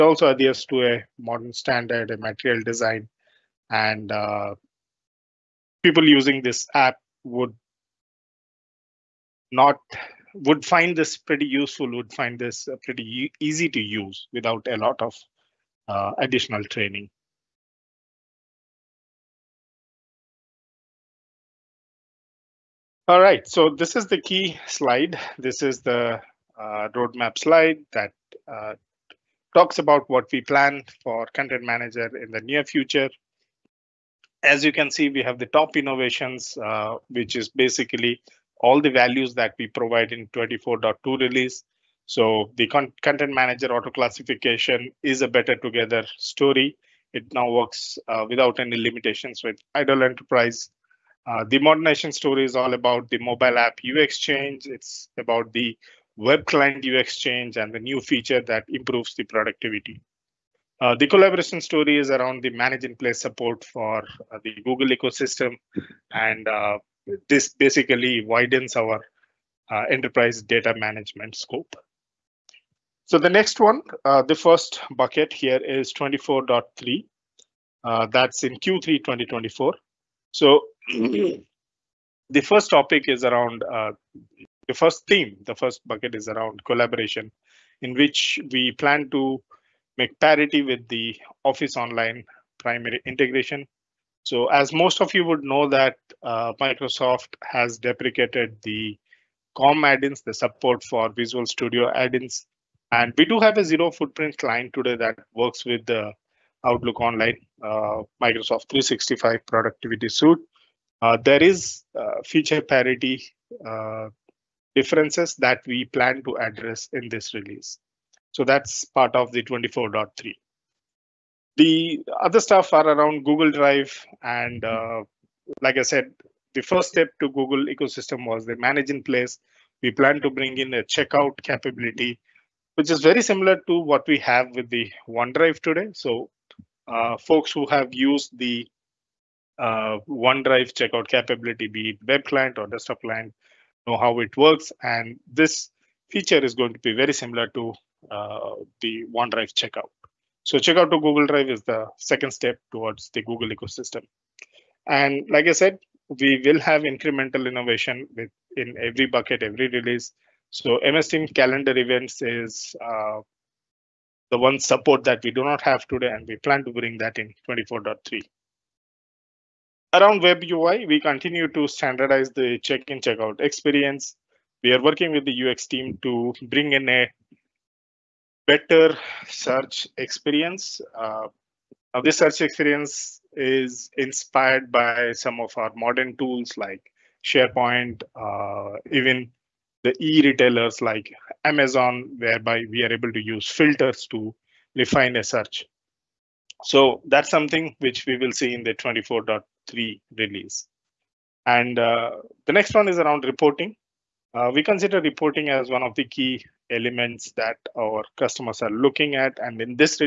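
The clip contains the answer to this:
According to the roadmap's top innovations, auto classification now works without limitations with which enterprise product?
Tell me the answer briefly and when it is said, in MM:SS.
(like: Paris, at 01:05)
IDOL Enterprise, at 00:49.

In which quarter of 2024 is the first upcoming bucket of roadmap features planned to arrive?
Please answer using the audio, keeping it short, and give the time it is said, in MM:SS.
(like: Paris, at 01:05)
Q3, at 01:18.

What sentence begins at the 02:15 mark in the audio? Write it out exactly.
So uh, folks who have used the uh, OneDrive checkout capability, be it web client or desktop client, know how it works.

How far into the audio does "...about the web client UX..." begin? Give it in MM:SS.
00:55.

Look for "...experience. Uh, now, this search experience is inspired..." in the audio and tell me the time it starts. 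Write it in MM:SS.
02:59.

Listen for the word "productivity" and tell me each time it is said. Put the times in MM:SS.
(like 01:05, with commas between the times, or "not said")
00:59, 01:49.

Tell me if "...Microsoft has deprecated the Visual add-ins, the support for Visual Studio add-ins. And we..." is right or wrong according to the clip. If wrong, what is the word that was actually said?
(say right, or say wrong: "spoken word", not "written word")
wrong: "COM", not "Visual".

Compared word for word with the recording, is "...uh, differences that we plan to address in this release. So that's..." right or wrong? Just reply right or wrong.
right.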